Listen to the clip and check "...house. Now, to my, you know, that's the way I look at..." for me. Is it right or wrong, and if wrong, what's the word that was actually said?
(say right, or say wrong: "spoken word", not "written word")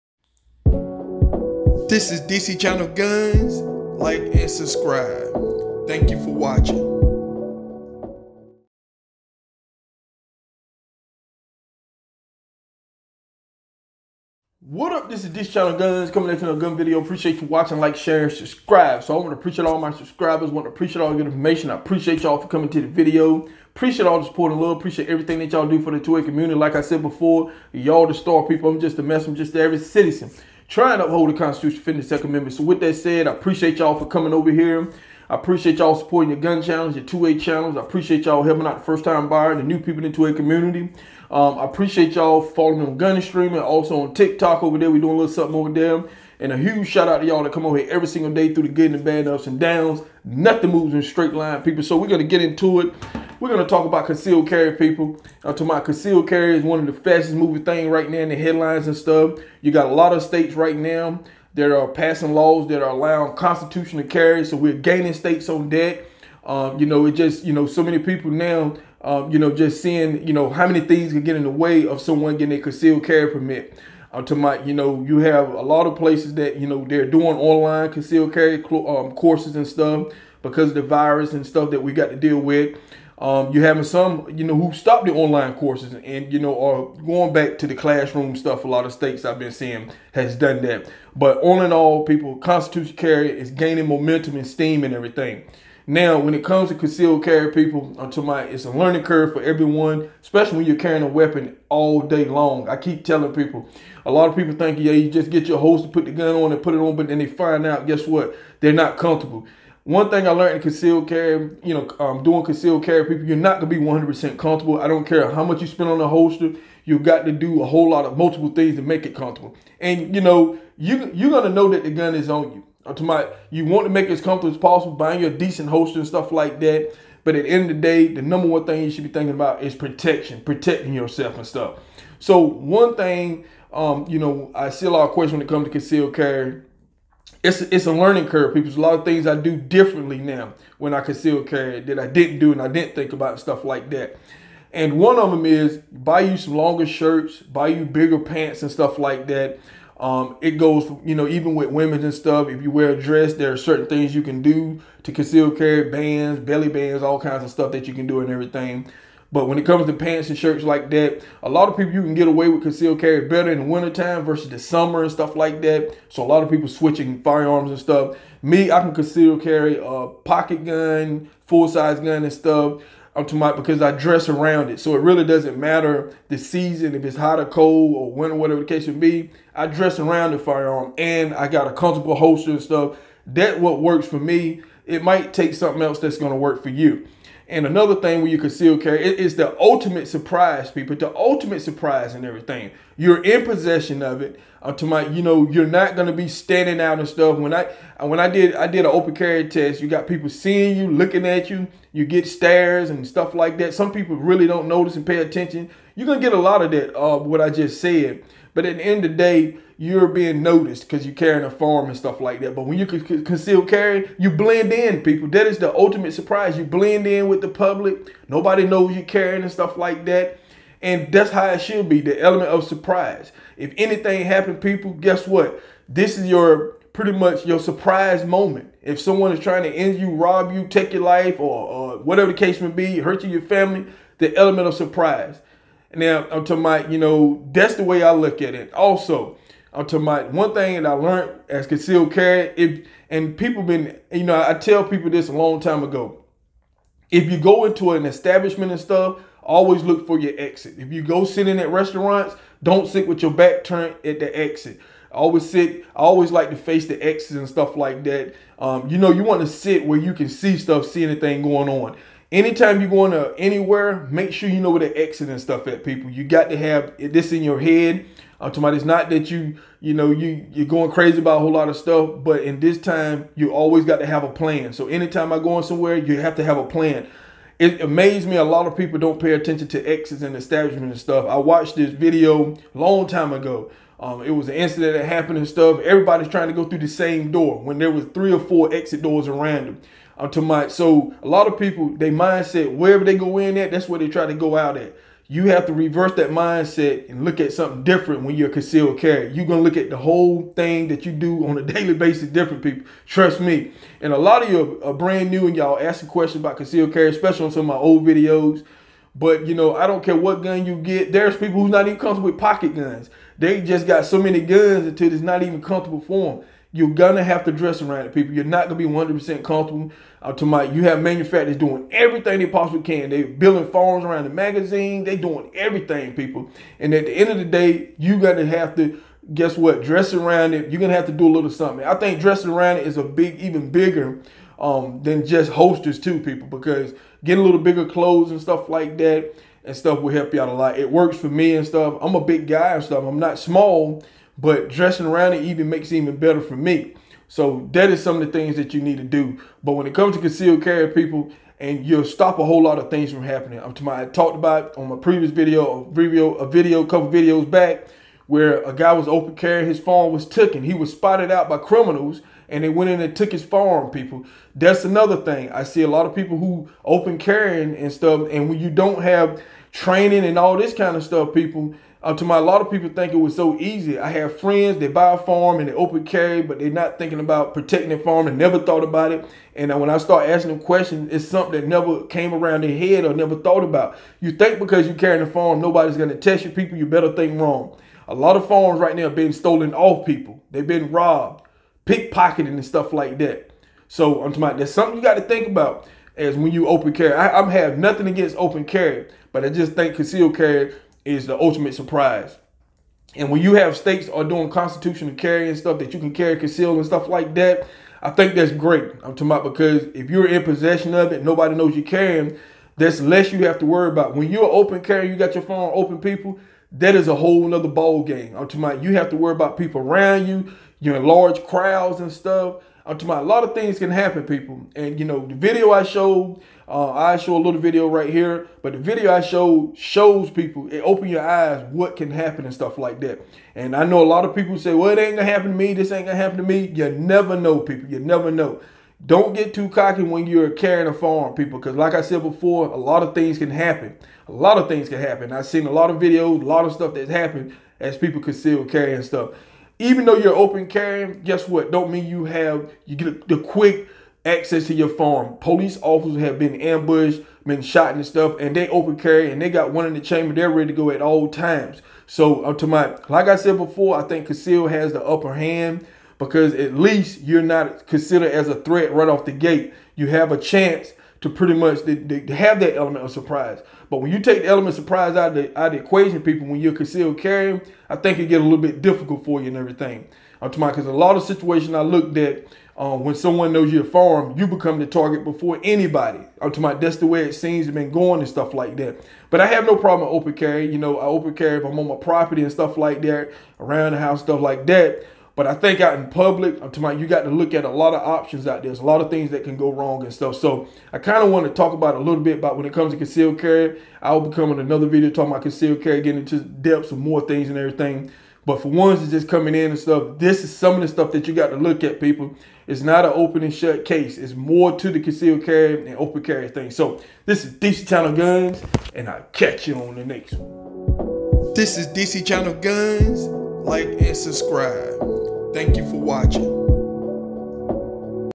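wrong: "surprise", not "house".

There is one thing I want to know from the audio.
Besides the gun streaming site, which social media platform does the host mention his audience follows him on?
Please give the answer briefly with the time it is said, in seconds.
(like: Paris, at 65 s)
TikTok, at 44 s.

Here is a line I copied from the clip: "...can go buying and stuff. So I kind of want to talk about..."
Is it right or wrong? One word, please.
wrong.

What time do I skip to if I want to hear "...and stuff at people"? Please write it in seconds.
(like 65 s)
265 s.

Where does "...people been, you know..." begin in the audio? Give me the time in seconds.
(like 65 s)
243 s.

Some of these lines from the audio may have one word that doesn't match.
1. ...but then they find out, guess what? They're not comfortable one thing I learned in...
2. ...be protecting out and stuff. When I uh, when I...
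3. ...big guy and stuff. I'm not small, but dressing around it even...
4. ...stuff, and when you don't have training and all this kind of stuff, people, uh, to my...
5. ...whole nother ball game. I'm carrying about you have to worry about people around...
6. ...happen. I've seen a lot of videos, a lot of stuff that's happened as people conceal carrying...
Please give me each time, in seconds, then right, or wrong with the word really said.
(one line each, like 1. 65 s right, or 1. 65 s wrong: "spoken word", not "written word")
1. 106 s right
2. 196 s wrong: "standing", not "protecting"
3. 342 s right
4. 367 s right
5. 417 s wrong: "talking", not "carrying"
6. 444 s right.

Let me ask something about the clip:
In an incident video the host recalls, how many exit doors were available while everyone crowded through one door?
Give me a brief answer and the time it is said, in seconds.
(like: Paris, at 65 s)
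3 or 4, at 288 s.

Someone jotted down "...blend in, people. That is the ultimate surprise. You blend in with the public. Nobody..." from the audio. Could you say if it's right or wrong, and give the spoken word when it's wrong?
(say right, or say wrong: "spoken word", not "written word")
right.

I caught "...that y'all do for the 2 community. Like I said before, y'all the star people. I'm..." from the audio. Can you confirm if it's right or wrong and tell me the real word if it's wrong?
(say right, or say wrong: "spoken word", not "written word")
right.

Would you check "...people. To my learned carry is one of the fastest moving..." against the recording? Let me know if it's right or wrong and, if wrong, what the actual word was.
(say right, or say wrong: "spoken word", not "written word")
wrong: "concealed", not "learned".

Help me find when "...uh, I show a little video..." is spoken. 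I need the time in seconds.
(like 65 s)
426 s.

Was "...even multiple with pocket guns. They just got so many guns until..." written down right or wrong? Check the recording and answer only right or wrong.
wrong.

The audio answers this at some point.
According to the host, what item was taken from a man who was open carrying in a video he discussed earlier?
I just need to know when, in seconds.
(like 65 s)
359 s.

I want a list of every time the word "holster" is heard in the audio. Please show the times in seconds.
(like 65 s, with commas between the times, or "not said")
116 s, 125 s, 182 s, 335 s.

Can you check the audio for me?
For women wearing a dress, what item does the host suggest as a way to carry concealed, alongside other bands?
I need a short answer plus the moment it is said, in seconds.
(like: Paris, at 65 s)
Belly bands, at 156 s.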